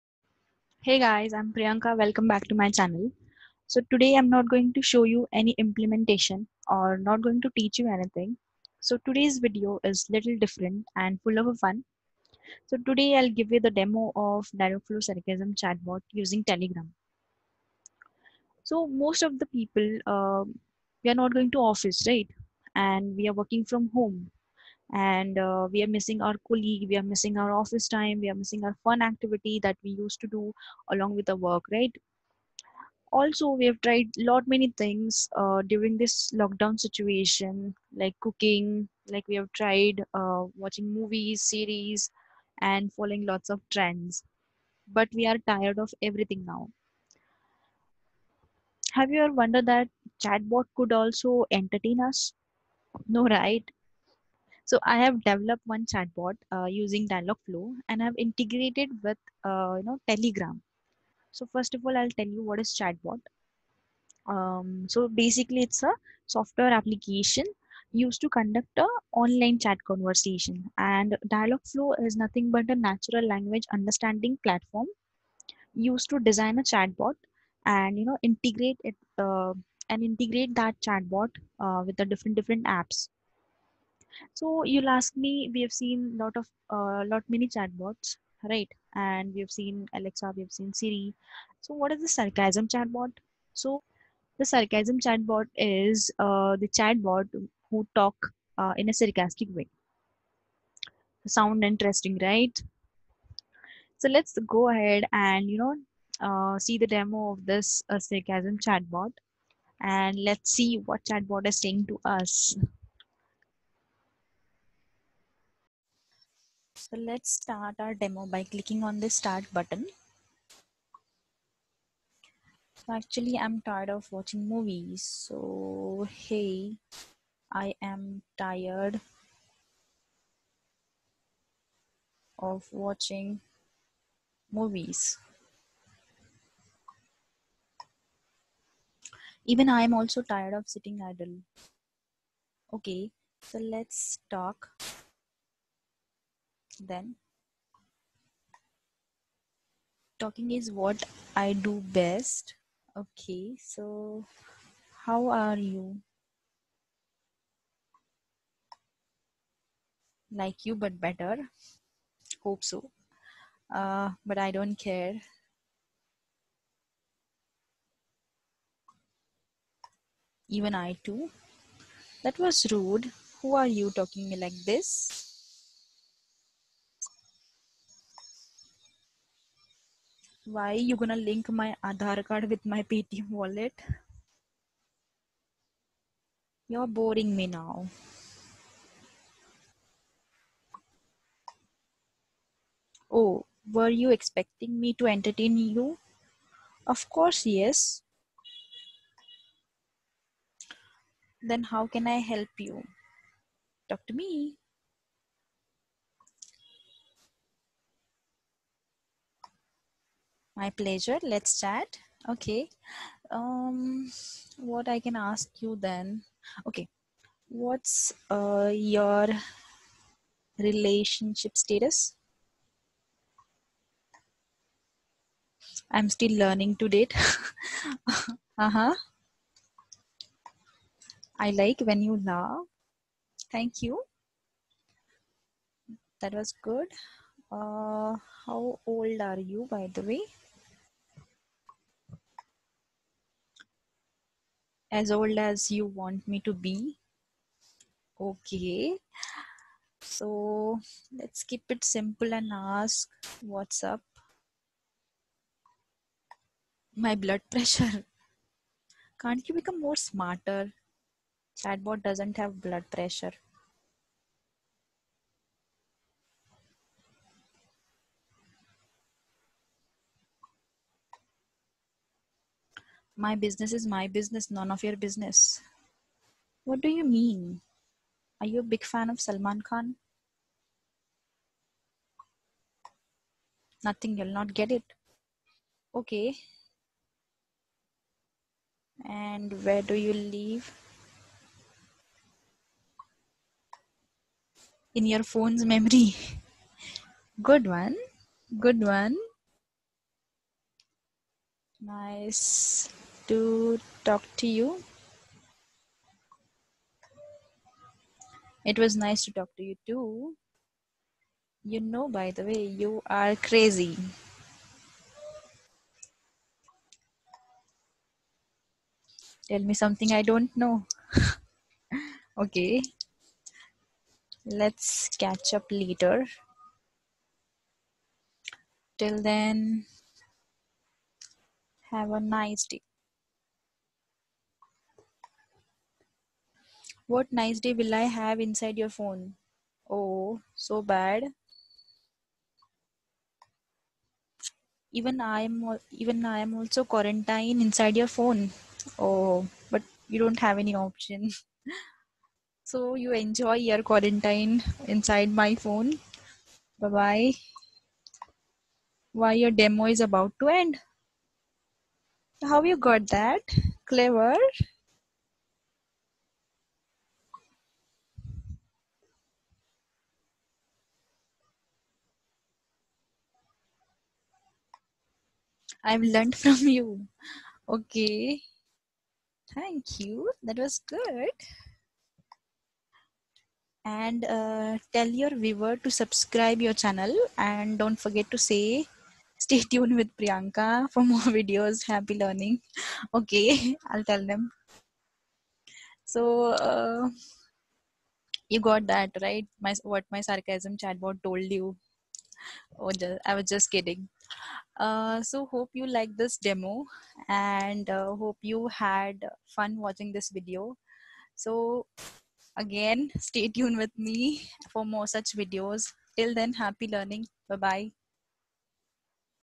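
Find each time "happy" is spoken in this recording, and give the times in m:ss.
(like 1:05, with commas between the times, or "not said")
6:31, 6:56.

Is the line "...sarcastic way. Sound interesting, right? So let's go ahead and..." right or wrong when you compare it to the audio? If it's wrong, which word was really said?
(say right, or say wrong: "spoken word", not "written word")
right.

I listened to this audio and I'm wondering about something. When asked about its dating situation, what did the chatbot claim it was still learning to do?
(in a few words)
date.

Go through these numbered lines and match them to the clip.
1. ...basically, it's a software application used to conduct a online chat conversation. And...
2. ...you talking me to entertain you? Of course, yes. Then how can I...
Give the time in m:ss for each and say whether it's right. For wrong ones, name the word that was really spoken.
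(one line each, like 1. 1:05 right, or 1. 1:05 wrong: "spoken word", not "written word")
1. 1:05 right
2. 3:13 wrong: "expecting", not "talking".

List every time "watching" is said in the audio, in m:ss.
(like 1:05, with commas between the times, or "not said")
0:40, 2:04, 2:12, 6:49.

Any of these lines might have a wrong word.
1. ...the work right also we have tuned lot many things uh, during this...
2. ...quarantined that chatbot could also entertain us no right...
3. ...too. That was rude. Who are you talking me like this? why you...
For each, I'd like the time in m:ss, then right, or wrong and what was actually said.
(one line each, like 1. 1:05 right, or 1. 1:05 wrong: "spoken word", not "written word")
1. 0:31 wrong: "tried", not "tuned"
2. 0:49 wrong: "wondered", not "quarantined"
3. 2:51 right.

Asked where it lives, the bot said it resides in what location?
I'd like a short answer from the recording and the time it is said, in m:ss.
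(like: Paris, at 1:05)
Your phone's memory, at 4:54.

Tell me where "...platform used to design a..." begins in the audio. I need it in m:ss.
1:14.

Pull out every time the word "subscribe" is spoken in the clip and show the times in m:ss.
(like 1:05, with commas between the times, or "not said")
6:25.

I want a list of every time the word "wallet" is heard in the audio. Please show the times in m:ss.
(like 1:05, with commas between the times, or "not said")
3:03.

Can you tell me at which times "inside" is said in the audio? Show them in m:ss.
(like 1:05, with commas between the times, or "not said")
5:38, 5:47, 5:54.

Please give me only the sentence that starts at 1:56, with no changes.
So let's start our demo by clicking on the start button.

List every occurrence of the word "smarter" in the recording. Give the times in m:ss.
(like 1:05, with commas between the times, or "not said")
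4:19.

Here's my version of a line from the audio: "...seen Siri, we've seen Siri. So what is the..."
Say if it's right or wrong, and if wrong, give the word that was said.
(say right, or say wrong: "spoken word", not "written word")
wrong: "Alexa", not "Siri".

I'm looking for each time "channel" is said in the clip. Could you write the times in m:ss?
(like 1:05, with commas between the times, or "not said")
0:02, 6:26.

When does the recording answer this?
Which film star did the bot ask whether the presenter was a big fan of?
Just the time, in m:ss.
4:39.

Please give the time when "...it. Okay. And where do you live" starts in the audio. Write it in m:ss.
4:44.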